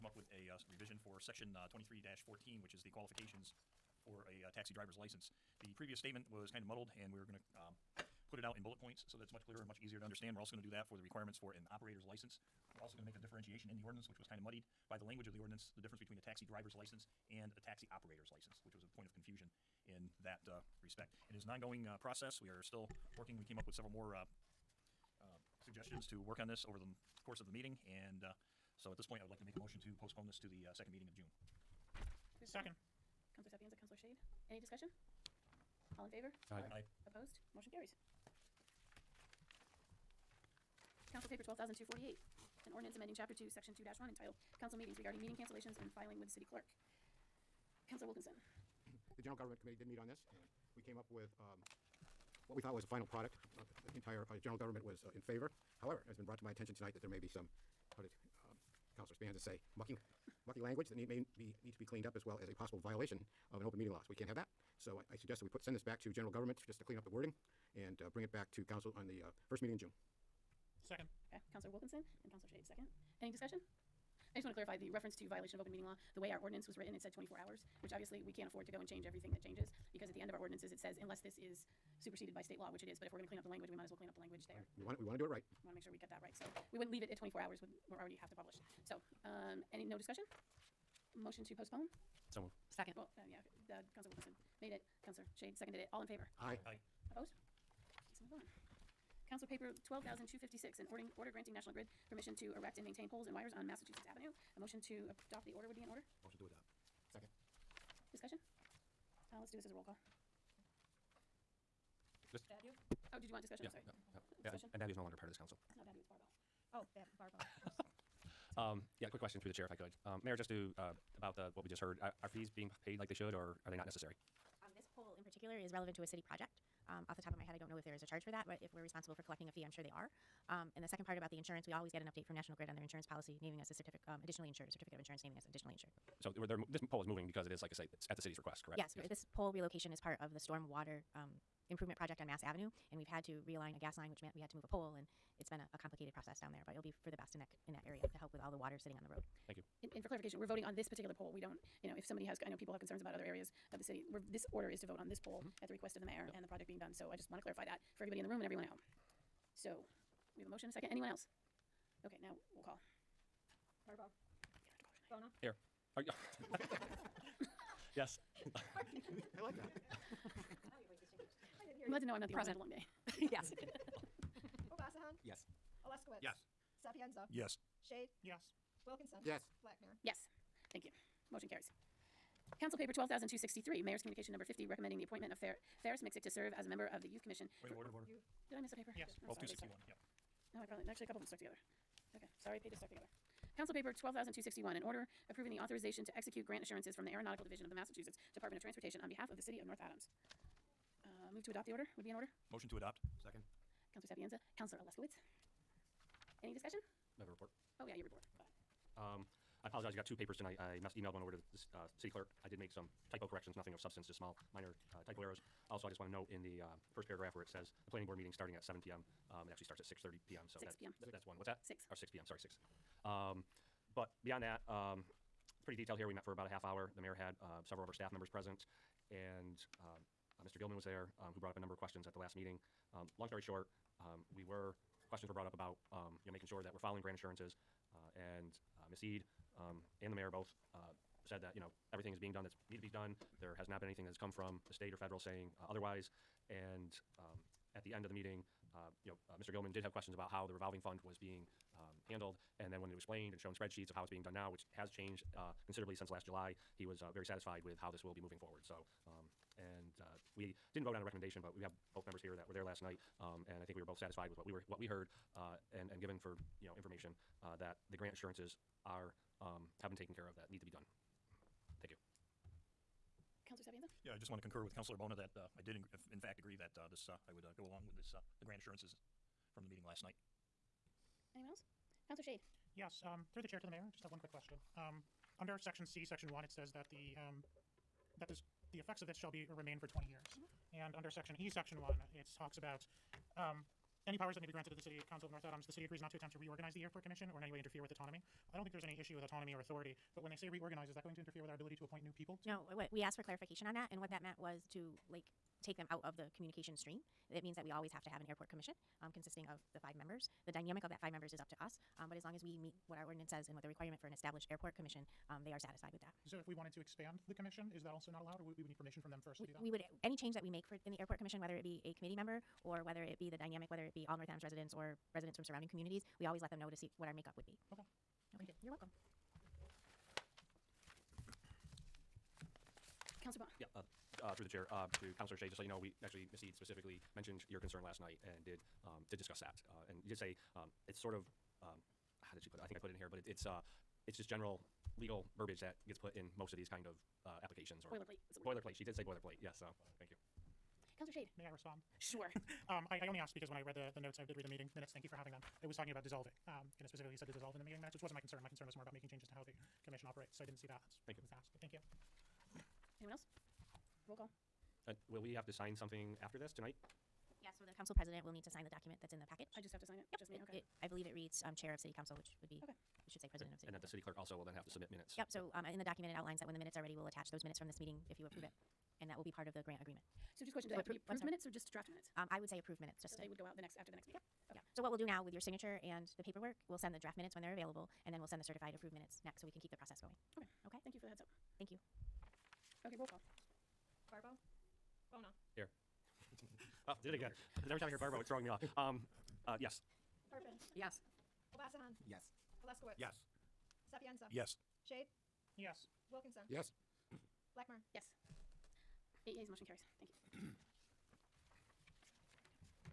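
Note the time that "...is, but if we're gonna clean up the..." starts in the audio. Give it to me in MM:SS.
01:22.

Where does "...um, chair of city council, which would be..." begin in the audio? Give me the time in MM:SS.
06:11.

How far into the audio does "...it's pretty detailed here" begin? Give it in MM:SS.
03:45.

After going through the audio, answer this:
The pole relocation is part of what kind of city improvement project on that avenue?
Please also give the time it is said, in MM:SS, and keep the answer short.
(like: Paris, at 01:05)
storm water, at 02:20.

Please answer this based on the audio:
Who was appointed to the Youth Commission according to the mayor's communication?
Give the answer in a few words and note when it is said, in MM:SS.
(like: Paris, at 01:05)
Ferris Mixick, at 03:05.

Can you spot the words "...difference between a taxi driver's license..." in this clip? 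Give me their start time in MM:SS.
00:15.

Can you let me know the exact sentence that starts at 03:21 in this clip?
Uh, Move to adopt the order would be in order.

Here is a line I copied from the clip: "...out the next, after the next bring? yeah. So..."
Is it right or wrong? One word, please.
wrong.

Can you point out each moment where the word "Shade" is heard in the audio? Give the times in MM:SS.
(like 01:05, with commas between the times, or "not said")
00:33, 01:12, 01:35, 02:57, 04:42, 05:51, 06:44.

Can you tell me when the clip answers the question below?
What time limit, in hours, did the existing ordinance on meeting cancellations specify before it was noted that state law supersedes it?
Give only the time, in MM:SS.
01:17.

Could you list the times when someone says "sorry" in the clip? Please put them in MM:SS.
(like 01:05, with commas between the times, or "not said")
01:53, 03:12, 03:42.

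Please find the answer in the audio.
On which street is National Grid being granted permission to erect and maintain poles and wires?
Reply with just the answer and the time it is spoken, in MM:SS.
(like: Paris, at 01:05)
Massachusetts Avenue, at 01:43.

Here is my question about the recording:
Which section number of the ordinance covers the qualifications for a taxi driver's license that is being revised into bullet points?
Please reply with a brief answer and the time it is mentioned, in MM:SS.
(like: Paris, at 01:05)
23-14, at 00:01.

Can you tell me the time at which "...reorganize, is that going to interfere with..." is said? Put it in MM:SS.
05:00.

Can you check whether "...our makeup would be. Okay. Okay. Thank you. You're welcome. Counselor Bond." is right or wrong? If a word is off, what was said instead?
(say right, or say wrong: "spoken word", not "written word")
right.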